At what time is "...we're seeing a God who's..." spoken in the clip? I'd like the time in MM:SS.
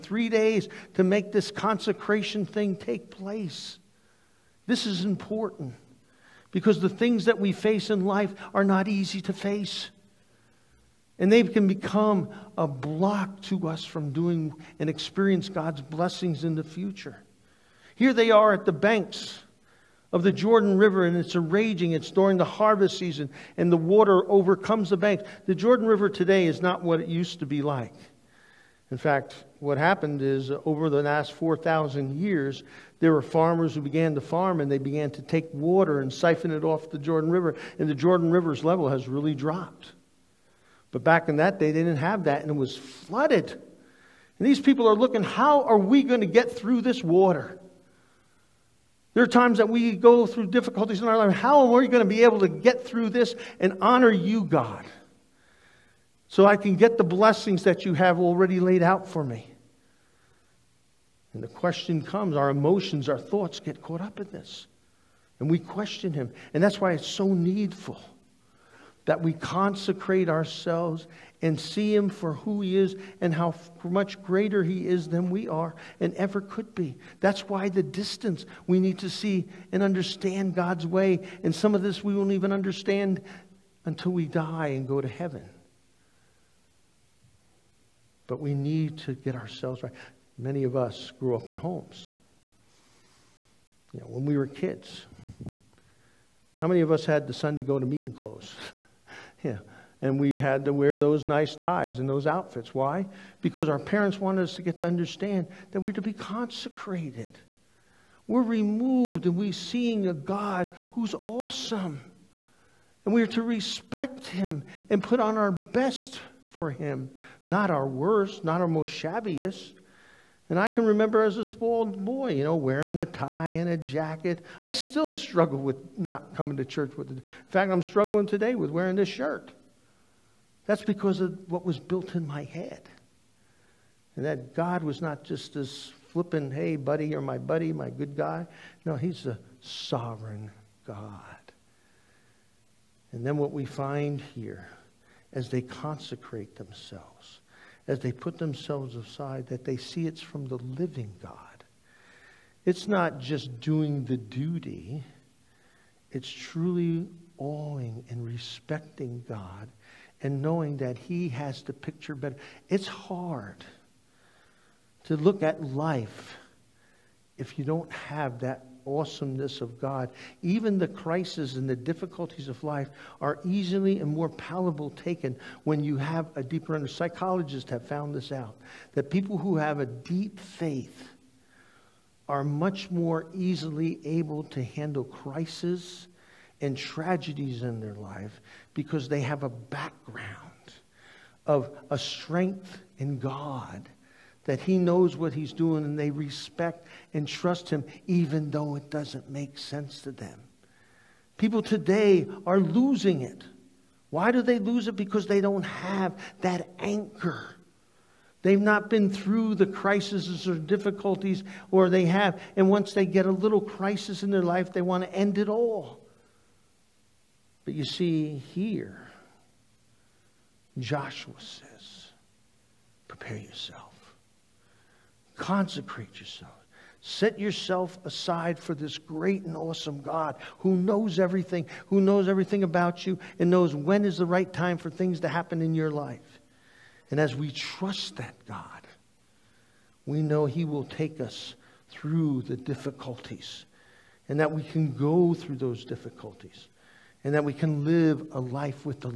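01:49.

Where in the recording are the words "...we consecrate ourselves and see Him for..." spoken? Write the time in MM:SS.
01:09.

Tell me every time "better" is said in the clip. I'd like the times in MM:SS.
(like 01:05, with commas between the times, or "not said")
02:42.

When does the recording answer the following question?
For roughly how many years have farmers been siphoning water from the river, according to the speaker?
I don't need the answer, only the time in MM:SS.
00:31.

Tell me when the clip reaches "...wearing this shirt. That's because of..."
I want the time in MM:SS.
02:08.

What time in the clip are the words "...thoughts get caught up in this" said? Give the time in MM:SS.
01:03.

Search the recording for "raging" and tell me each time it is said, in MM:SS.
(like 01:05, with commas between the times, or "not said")
00:21.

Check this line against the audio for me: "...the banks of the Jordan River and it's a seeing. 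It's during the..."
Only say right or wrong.
wrong.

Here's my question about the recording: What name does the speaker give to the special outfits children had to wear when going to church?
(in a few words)
Sunday go to meeting clothes.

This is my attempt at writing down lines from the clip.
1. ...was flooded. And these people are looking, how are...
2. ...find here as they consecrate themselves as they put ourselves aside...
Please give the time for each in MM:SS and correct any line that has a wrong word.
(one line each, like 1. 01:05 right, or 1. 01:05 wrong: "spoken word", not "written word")
1. 00:42 right
2. 02:23 wrong: "themselves", not "ourselves".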